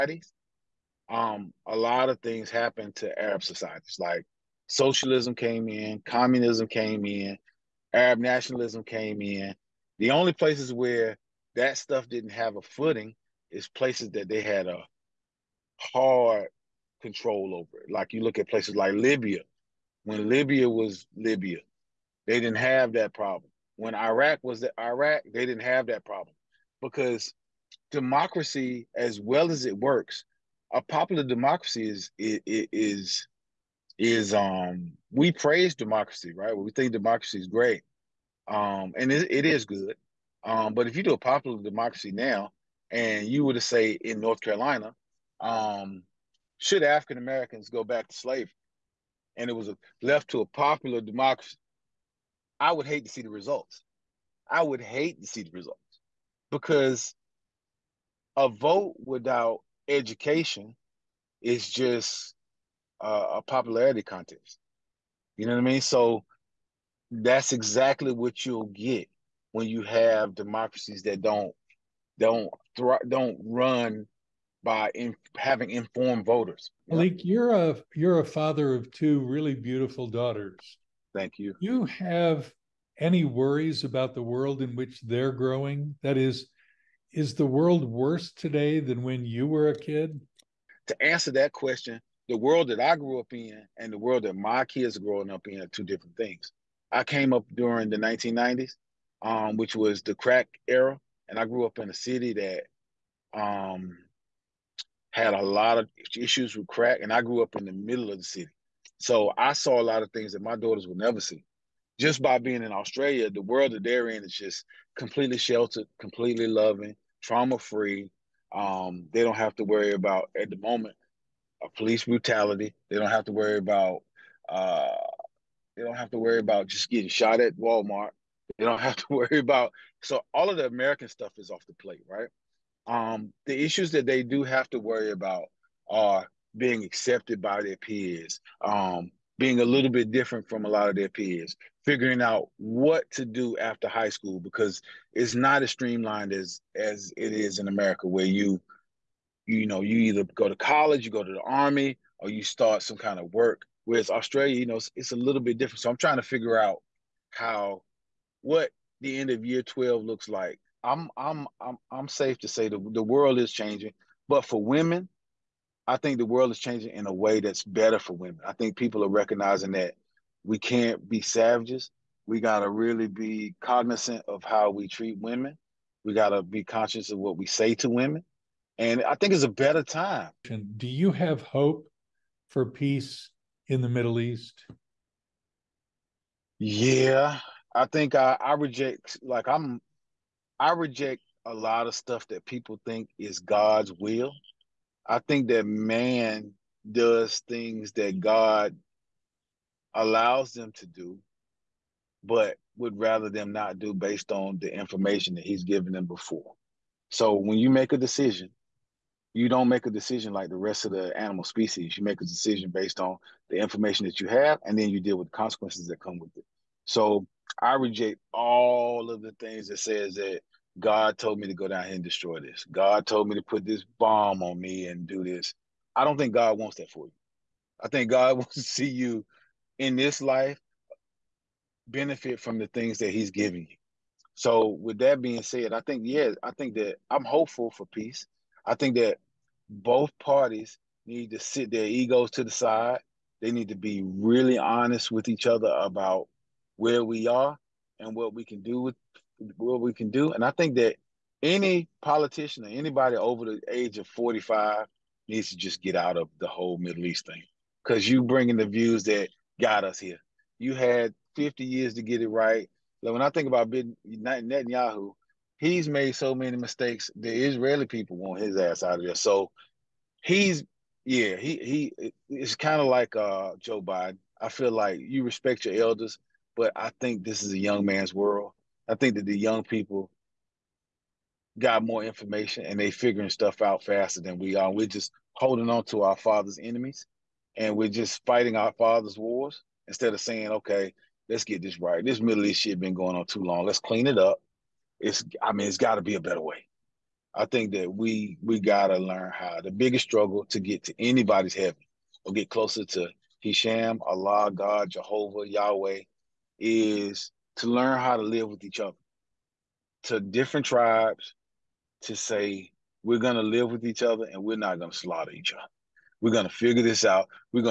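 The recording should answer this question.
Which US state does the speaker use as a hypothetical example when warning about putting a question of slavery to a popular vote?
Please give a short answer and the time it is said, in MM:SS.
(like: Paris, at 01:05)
North Carolina, at 00:44.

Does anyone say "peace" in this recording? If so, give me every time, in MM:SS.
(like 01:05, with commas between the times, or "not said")
03:02, 03:57.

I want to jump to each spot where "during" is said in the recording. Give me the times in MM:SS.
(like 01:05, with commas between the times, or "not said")
01:37.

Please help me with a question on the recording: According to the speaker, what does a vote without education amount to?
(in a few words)
A popularity contest.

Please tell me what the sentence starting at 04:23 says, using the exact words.
Like when I think about Netanyahu, he's made so many mistakes.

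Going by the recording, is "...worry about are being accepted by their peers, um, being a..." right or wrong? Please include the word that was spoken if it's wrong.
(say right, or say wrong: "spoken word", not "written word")
right.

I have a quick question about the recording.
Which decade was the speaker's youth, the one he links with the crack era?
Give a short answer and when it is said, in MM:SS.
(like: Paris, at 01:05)
1990s, at 01:37.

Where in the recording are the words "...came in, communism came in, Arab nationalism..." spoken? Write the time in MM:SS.
00:05.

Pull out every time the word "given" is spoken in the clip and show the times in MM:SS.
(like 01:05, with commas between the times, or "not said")
03:25.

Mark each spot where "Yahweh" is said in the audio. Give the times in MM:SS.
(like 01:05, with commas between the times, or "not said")
05:05.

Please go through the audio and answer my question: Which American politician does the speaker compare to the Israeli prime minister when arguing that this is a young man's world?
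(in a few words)
Joe Biden.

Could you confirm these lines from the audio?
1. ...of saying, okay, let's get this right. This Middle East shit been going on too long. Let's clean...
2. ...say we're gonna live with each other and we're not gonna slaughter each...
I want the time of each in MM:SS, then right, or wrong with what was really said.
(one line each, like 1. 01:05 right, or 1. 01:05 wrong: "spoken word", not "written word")
1. 04:50 right
2. 05:12 right.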